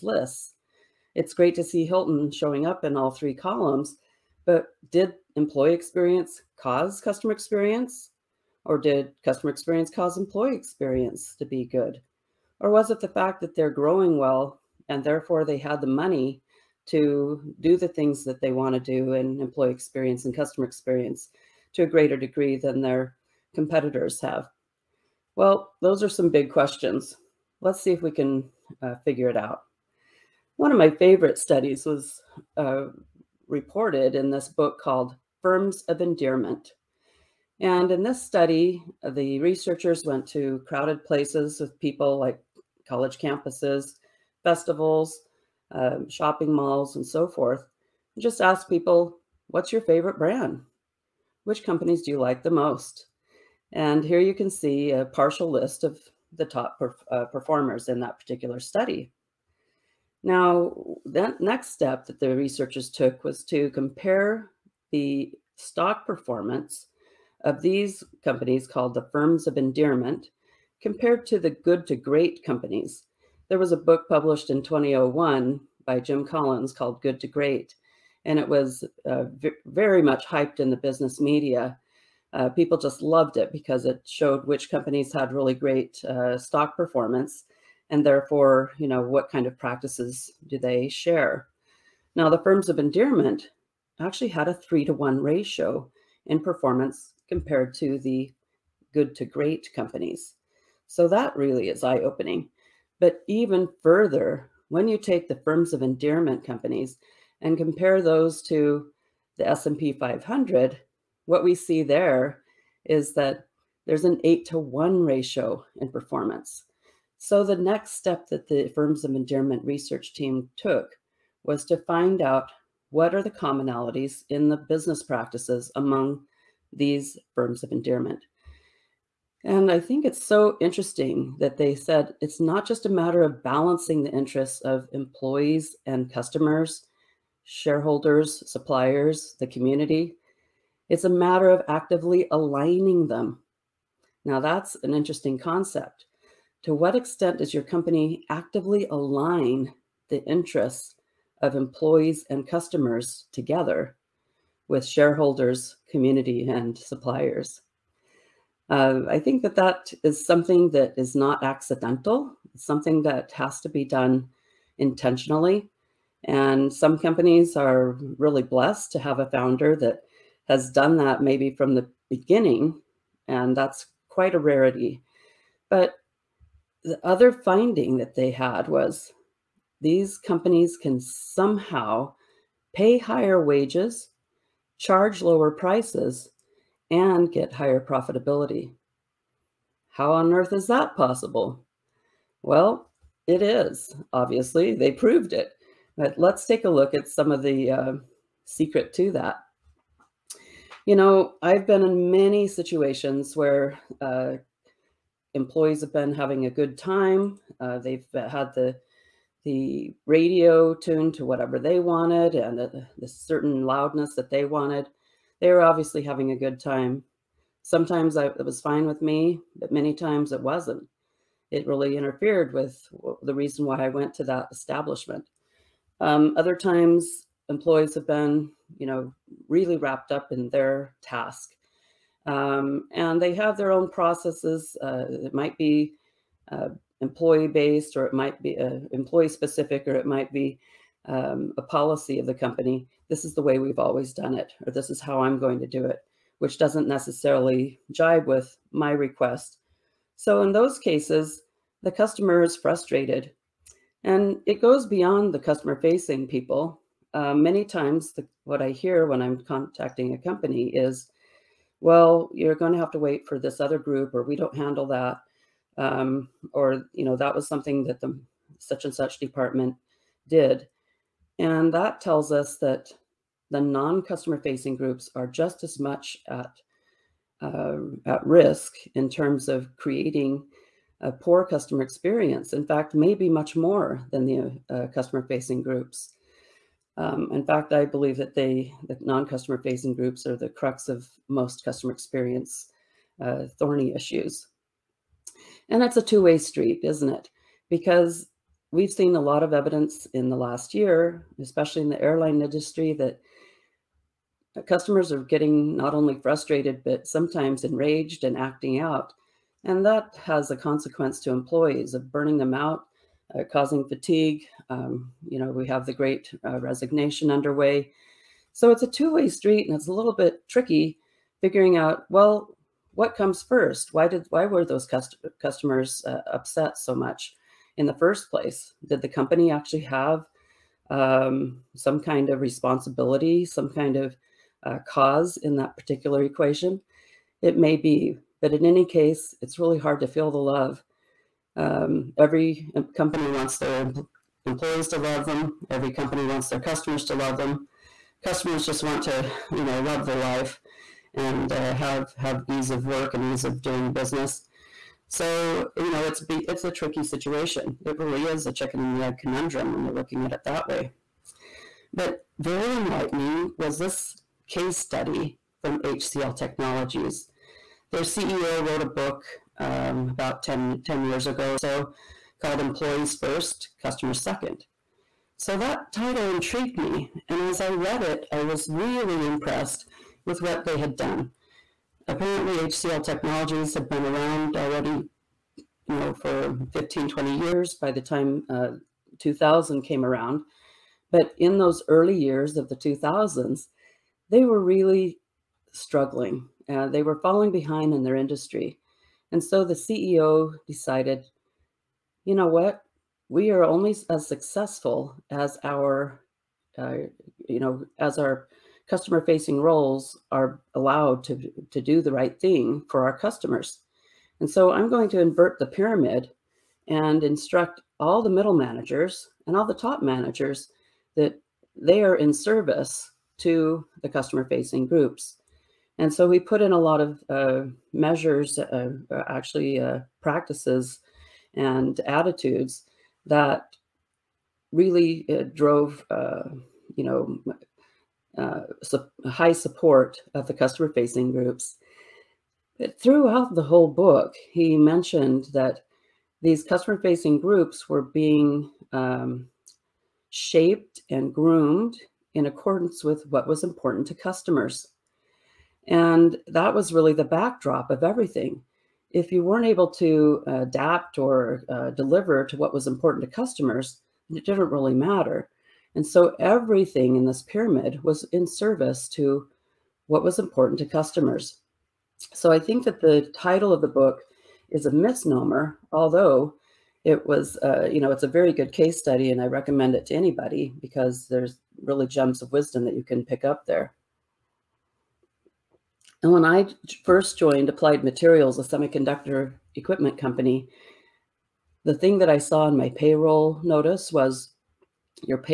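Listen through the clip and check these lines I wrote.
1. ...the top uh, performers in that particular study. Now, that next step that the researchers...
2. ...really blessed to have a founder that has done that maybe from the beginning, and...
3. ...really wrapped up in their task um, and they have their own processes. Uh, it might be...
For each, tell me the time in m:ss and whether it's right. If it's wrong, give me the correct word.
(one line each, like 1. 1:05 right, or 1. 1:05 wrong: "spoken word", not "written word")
1. 0:56 right
2. 2:48 right
3. 3:49 right.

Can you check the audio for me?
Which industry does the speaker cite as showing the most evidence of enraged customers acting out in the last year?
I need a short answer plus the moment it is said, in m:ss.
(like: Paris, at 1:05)
airline industry, at 5:02.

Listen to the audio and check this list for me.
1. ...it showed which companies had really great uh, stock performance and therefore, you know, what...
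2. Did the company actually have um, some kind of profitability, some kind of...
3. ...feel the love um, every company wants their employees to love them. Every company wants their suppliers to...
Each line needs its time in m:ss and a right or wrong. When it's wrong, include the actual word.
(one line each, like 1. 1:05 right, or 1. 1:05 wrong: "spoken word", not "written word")
1. 1:23 right
2. 5:28 wrong: "responsibility", not "profitability"
3. 5:40 wrong: "customers", not "suppliers".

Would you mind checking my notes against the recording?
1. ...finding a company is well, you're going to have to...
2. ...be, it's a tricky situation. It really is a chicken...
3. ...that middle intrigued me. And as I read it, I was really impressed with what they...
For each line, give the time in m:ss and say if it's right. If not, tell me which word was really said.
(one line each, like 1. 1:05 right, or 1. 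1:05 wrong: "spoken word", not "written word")
1. 4:19 wrong: "contacting", not "finding"
2. 5:56 right
3. 6:15 wrong: "title", not "middle".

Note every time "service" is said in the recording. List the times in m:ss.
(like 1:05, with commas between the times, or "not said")
7:02, 7:48.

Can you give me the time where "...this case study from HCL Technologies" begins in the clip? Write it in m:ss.
6:03.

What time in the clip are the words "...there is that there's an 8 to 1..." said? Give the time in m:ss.
1:51.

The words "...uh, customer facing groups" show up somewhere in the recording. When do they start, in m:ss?
4:44.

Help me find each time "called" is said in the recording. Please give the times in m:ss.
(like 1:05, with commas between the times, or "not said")
0:34, 1:08, 1:16, 6:12.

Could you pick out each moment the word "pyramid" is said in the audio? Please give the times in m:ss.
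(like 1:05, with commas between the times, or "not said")
6:55, 7:47.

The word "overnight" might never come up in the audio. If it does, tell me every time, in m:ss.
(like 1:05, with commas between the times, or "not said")
not said.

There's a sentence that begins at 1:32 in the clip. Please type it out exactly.
Now, the firms of endearment actually had a three to one ratio in performance compared to the good to great companies.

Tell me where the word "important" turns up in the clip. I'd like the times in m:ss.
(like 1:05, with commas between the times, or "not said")
7:33, 7:42, 7:50.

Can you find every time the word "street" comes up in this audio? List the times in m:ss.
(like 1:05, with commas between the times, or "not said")
4:56, 5:19.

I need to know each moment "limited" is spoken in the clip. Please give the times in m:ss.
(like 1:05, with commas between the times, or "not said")
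not said.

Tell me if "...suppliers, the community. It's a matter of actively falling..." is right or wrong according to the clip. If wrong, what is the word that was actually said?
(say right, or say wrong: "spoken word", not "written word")
wrong: "aligning", not "falling".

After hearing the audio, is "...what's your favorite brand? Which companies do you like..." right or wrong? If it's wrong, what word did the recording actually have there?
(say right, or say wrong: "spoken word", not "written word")
right.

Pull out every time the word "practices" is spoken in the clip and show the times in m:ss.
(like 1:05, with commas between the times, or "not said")
1:29, 2:05, 7:10.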